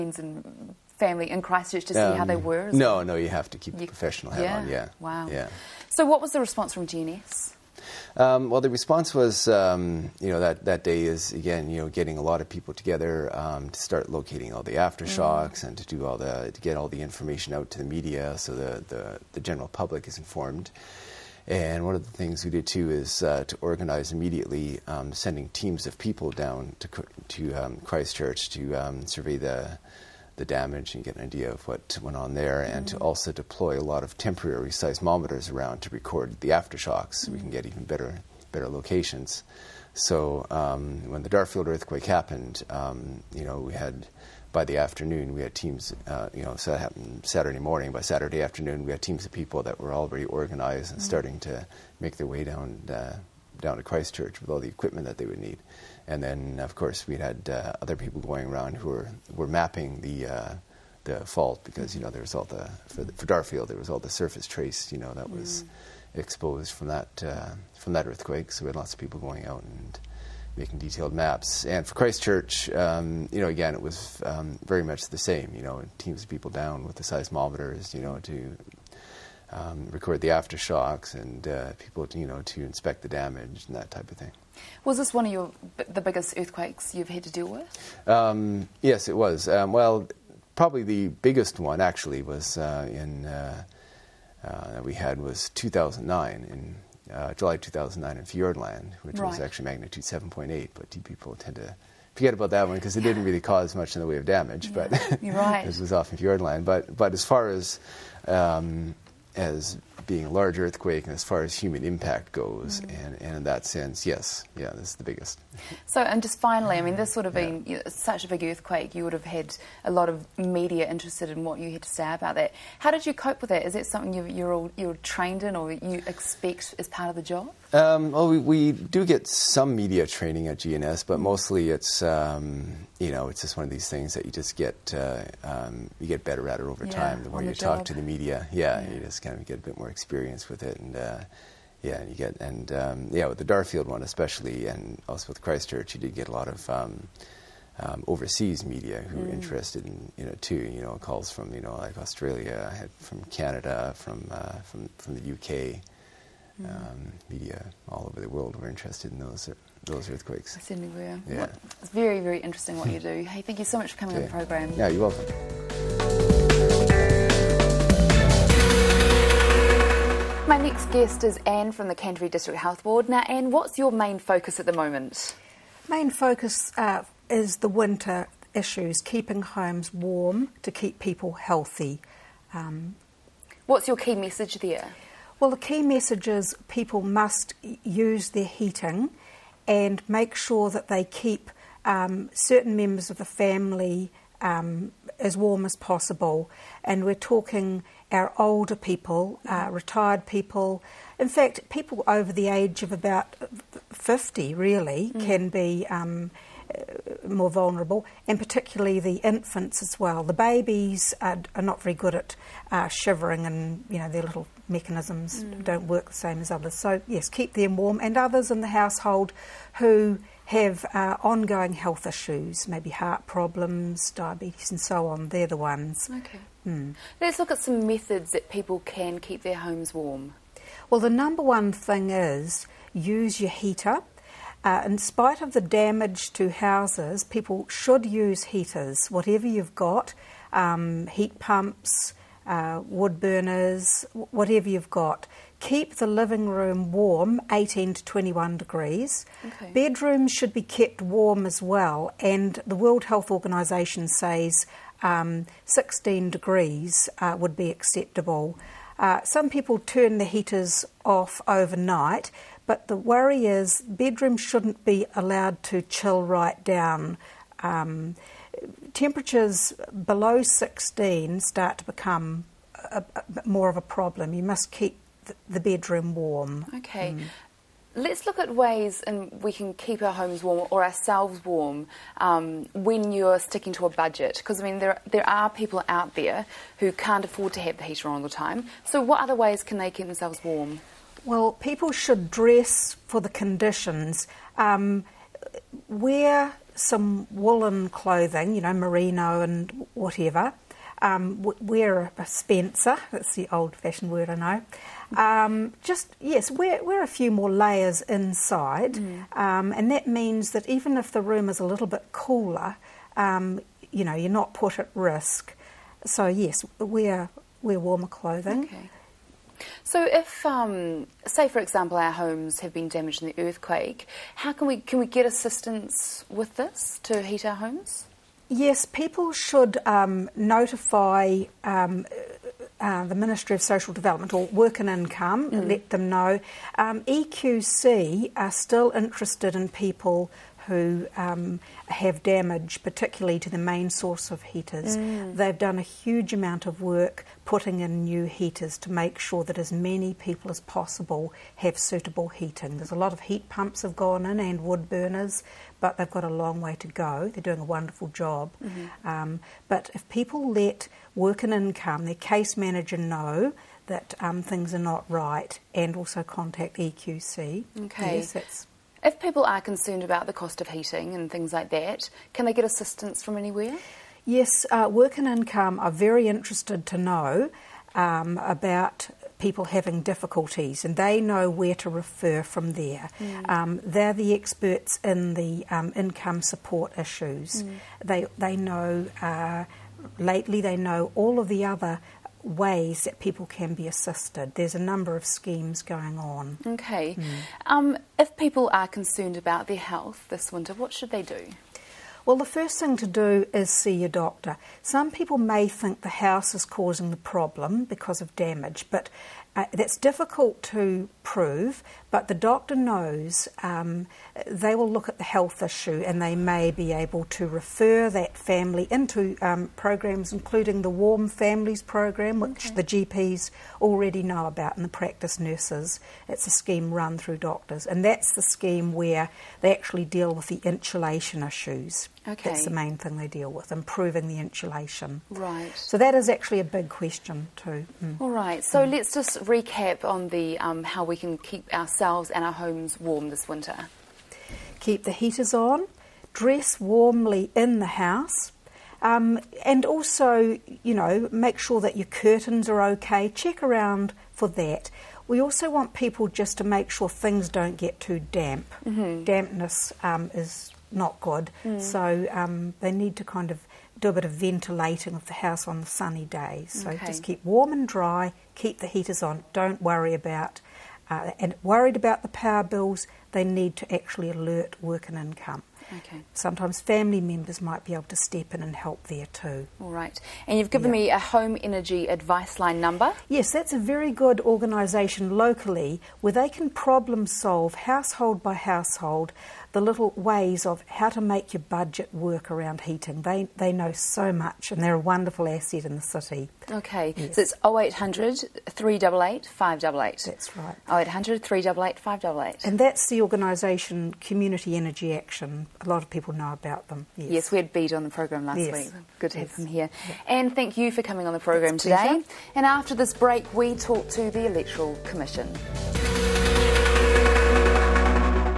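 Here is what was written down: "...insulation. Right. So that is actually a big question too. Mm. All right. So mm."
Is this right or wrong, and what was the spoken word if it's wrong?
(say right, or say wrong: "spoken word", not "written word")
right.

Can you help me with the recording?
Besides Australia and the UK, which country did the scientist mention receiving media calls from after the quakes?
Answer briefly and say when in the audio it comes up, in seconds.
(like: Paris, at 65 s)
Canada, at 152 s.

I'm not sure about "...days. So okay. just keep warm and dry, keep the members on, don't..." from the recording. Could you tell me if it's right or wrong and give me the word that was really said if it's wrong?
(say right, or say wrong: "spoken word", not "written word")
wrong: "heaters", not "members".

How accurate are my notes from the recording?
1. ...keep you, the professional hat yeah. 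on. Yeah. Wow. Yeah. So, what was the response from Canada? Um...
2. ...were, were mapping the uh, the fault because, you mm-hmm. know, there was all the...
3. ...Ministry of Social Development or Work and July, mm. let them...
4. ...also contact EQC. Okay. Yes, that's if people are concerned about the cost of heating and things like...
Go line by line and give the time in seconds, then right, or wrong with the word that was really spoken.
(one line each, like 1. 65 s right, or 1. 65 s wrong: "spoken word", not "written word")
1. 3 s wrong: "GNS", not "Canada"
2. 58 s right
3. 333 s wrong: "Income", not "July"
4. 365 s right.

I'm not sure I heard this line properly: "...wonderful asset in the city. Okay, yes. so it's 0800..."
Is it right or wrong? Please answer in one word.
right.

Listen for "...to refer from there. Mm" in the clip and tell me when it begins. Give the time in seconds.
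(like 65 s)
381 s.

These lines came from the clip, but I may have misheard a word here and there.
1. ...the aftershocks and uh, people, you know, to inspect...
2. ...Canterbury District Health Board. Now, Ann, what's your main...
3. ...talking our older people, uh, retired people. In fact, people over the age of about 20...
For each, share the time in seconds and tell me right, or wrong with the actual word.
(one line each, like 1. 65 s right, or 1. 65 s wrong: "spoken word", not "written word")
1. 80 s right
2. 171 s right
3. 197 s wrong: "50", not "20".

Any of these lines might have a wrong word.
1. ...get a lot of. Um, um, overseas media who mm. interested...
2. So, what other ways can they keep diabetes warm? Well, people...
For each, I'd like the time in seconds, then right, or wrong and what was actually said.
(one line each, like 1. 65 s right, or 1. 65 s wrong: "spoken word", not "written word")
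1. 146 s right
2. 288 s wrong: "themselves", not "diabetes".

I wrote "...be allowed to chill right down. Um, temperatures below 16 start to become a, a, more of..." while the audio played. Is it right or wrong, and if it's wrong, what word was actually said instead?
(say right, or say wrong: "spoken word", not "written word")
right.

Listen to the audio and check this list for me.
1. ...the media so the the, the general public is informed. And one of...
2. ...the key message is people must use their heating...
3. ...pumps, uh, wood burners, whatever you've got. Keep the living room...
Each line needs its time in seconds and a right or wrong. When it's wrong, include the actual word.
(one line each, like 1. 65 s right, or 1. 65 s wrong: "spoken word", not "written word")
1. 17 s right
2. 185 s right
3. 241 s right.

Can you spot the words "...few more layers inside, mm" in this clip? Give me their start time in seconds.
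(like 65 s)
307 s.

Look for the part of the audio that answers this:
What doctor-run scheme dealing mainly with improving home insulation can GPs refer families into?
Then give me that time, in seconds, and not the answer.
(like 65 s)
420 s.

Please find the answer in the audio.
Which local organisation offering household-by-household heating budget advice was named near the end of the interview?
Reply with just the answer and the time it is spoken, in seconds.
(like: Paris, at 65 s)
Community Energy Action, at 504 s.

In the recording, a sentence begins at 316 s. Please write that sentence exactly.
So, yes, we're, we're warmer clothing.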